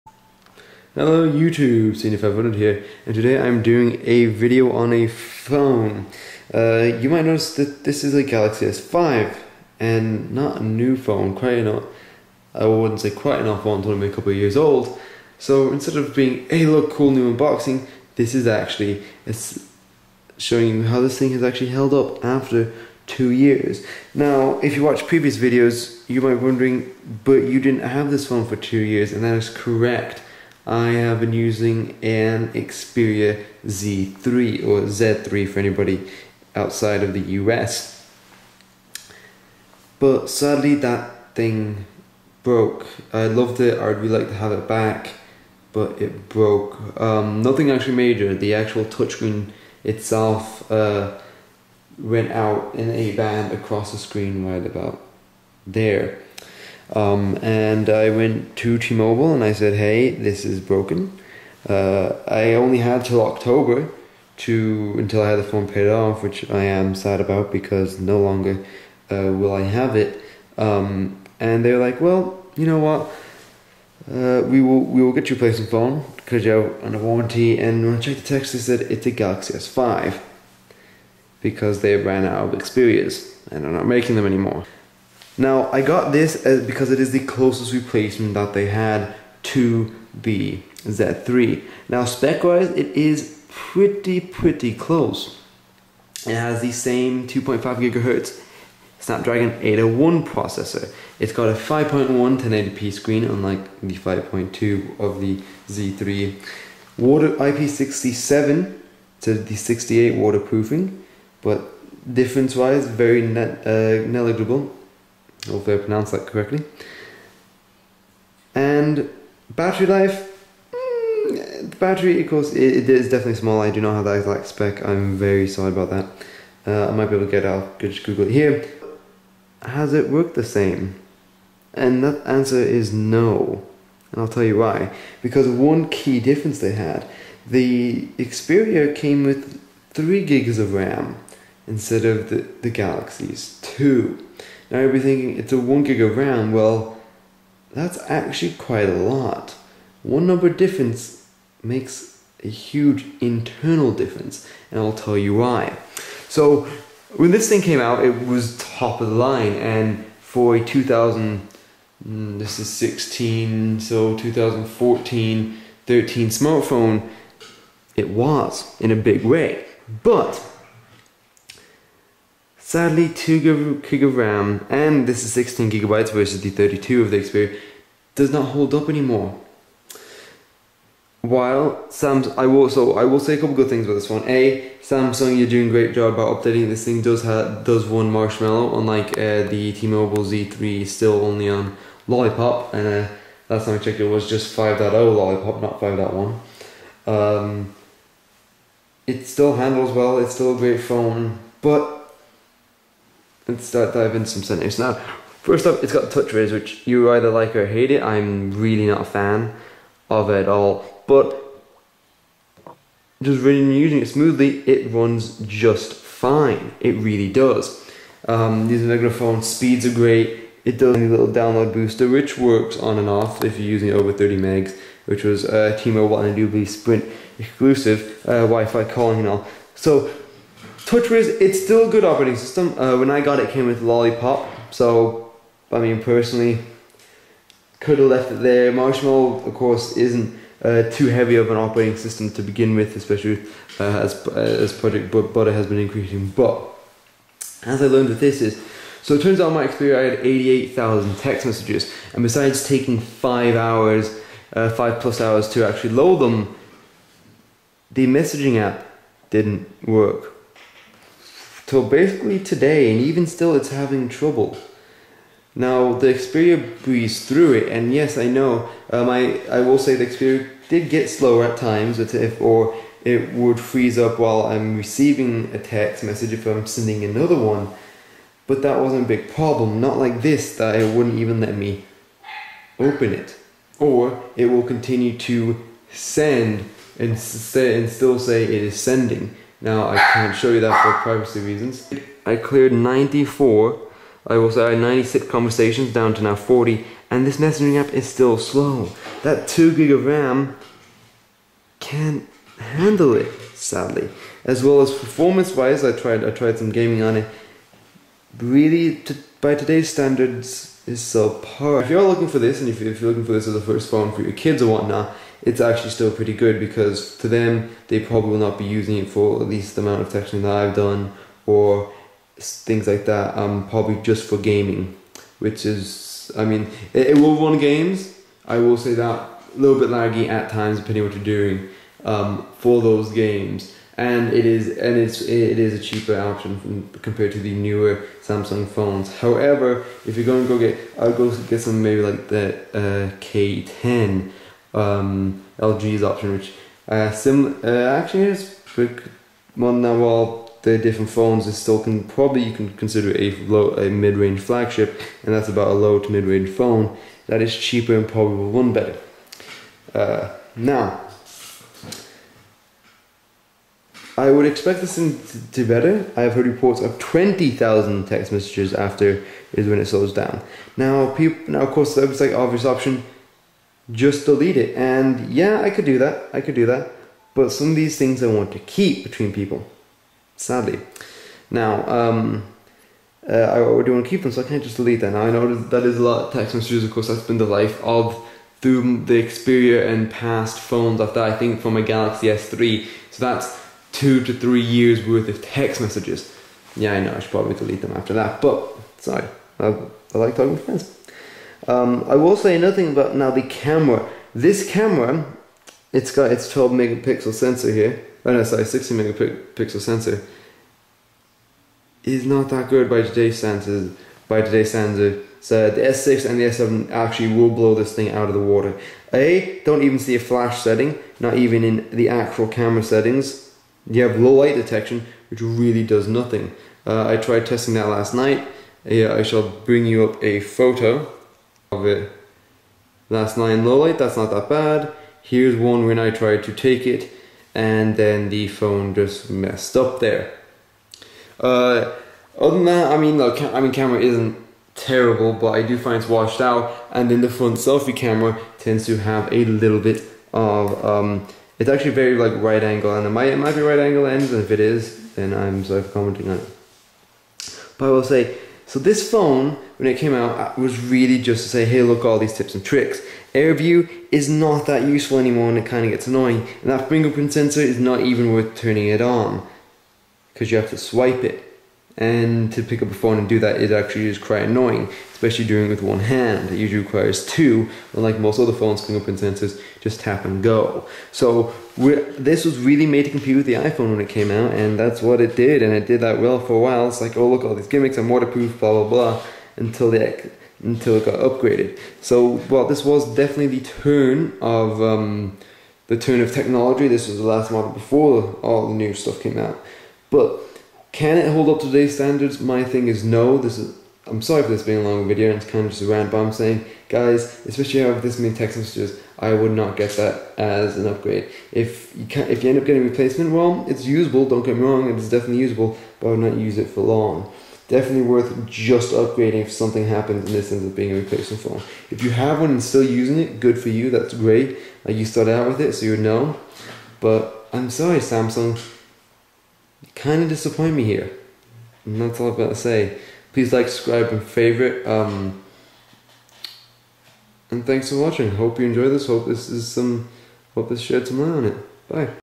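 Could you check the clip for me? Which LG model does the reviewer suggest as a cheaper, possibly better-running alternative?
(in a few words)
K10.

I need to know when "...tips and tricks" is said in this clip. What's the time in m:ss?
7:42.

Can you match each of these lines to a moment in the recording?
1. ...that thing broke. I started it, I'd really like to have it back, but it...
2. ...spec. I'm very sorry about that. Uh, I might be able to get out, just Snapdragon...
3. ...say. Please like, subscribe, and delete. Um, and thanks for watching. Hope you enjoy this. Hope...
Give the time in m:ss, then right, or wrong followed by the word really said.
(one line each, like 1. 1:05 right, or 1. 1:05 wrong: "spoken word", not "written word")
1. 0:40 wrong: "loved", not "started"
2. 2:04 wrong: "Google", not "Snapdragon"
3. 8:52 wrong: "favorite", not "delete".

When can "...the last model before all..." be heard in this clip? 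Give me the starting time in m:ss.
8:17.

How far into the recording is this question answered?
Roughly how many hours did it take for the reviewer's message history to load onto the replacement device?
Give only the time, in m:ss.
4:14.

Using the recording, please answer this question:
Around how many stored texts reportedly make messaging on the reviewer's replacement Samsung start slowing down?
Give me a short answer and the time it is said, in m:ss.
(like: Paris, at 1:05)
20,000, at 6:06.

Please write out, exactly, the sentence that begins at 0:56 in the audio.
Um, and I went to T Mobile and I said, hey, this is broken.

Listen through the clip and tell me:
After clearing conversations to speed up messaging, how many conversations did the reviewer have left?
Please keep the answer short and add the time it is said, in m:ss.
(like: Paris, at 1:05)
40, at 4:56.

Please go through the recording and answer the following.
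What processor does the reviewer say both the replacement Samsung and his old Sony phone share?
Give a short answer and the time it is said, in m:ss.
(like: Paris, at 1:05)
Snapdragon 801, at 1:38.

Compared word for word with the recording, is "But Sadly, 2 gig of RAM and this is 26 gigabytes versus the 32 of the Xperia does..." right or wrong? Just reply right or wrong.
wrong.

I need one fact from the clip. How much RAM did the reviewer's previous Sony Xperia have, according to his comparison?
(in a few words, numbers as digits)
3 gigs.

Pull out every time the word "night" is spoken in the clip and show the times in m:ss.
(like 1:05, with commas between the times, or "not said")
7:08, 7:13.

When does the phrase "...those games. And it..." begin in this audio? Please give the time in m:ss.
5:32.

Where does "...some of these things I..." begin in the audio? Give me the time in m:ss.
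6:17.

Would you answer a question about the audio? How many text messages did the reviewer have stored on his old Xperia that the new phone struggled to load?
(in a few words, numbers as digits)
88,000.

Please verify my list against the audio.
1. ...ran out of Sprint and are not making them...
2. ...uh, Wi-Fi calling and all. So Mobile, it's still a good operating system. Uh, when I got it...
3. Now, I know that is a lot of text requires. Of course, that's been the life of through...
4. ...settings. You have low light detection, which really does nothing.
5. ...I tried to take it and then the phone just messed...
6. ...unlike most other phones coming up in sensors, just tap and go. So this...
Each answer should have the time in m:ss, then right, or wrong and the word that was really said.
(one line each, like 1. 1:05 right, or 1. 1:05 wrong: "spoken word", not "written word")
1. 1:21 wrong: "Xperias", not "Sprint"
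2. 3:48 wrong: "TouchWiz", not "Mobile"
3. 6:25 wrong: "messages", not "requires"
4. 7:02 right
5. 7:15 right
6. 7:57 right.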